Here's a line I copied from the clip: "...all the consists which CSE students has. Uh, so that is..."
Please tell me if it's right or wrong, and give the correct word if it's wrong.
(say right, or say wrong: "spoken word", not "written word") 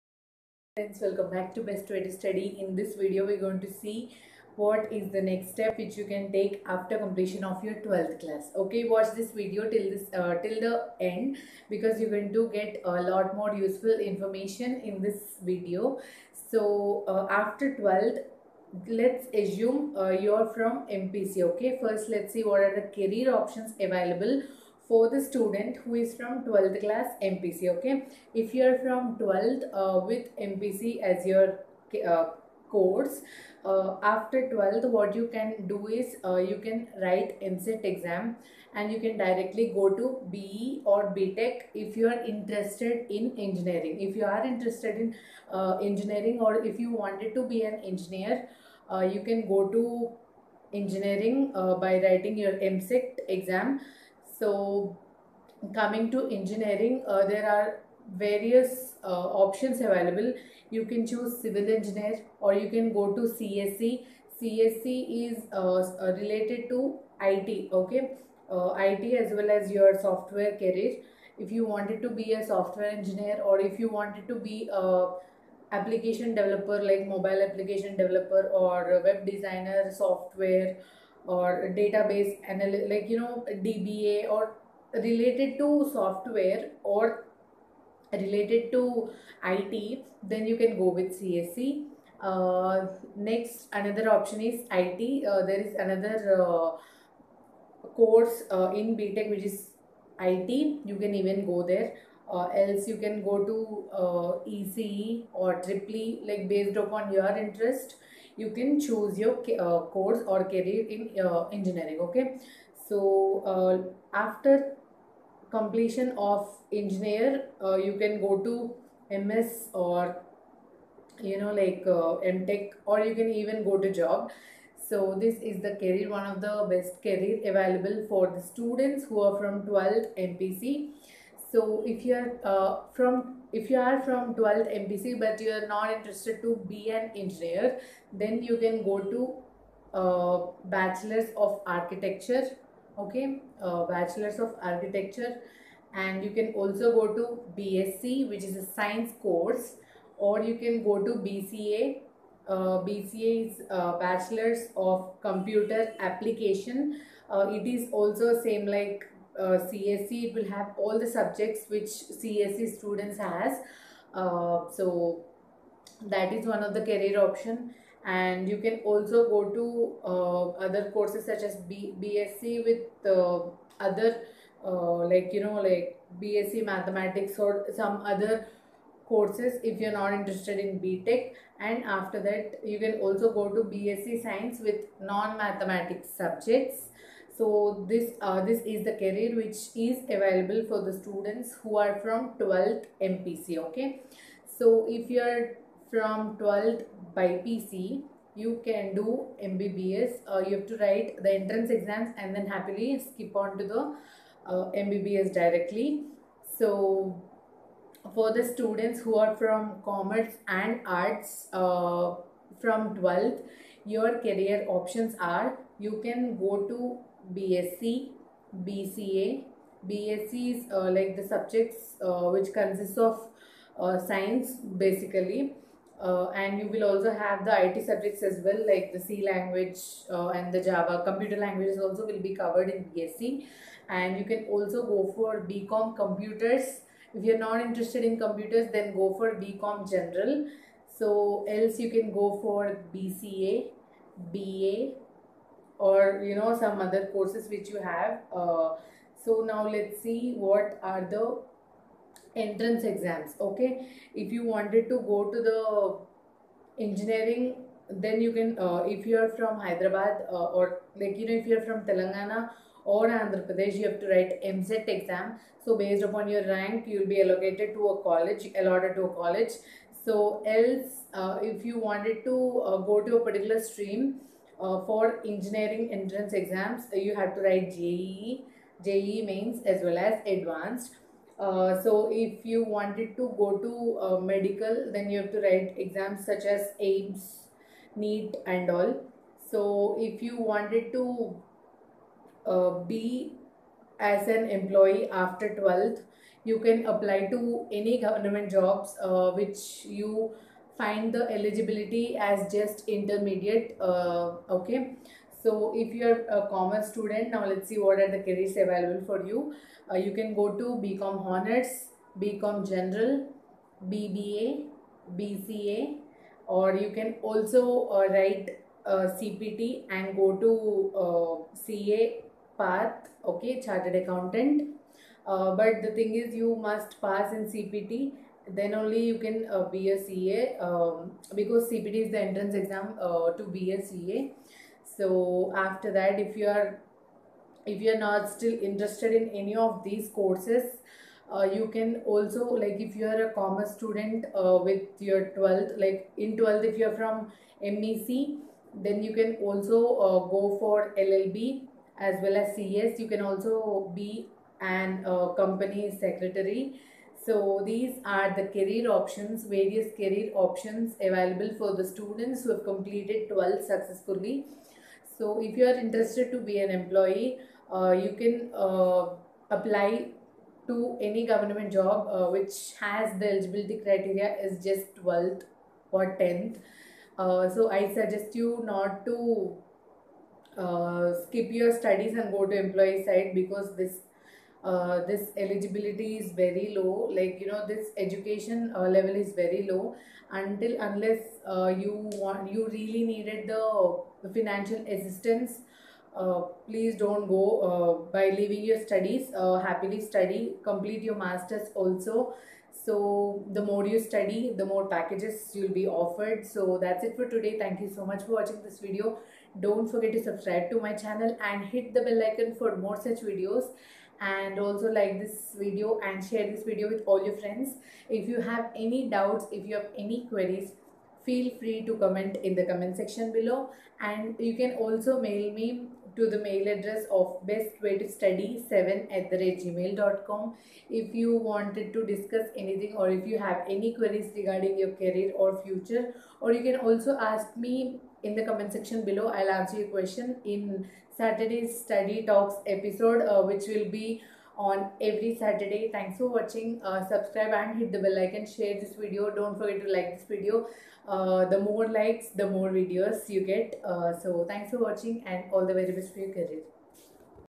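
wrong: "subjects", not "consists".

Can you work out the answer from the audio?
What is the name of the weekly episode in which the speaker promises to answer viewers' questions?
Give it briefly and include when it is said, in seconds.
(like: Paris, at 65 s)
Study Talks, at 441 s.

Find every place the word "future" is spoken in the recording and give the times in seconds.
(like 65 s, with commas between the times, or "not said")
435 s.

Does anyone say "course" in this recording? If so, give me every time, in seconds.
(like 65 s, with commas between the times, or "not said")
32 s, 97 s, 109 s, 149 s, 170 s, 179 s, 247 s, 340 s.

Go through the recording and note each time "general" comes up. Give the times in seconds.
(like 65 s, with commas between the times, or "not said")
239 s, 312 s.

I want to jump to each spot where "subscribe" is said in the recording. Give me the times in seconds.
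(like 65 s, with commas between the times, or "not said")
410 s, 447 s.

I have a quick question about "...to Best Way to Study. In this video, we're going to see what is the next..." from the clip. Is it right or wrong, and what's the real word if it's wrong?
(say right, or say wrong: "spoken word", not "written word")
right.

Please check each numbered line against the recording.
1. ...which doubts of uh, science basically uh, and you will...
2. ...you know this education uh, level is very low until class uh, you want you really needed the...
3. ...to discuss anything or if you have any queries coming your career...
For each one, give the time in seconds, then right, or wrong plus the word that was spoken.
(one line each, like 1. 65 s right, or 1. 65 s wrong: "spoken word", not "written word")
1. 222 s wrong: "consists", not "doubts"
2. 387 s wrong: "unless", not "class"
3. 431 s wrong: "regarding", not "coming".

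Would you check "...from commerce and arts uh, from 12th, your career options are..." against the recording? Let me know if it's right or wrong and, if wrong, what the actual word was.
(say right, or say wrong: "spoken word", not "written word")
right.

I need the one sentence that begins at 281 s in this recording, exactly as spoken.
Uh, so if you wanted to go to uh, medical, then you have to write exams such as AIIMS, NEET and all.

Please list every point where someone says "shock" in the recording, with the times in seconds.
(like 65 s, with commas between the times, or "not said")
not said.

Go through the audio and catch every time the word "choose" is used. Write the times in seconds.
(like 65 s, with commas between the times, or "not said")
61 s, 108 s.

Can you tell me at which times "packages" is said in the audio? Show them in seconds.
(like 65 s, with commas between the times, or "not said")
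404 s.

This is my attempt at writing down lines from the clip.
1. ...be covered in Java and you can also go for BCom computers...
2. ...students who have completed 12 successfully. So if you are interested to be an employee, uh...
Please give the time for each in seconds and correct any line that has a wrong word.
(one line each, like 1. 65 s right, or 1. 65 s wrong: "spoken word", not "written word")
1. 232 s wrong: "BSc", not "Java"
2. 361 s right.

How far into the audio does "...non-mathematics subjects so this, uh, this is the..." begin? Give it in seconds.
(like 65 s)
184 s.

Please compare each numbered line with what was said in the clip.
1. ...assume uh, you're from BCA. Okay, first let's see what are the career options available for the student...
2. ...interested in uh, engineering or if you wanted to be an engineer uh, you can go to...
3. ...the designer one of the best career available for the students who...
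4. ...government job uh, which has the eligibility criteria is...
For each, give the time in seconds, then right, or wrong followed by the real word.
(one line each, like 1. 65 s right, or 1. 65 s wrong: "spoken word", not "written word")
1. 19 s wrong: "MPC", not "BCA"
2. 44 s right
3. 125 s wrong: "career", not "designer"
4. 371 s right.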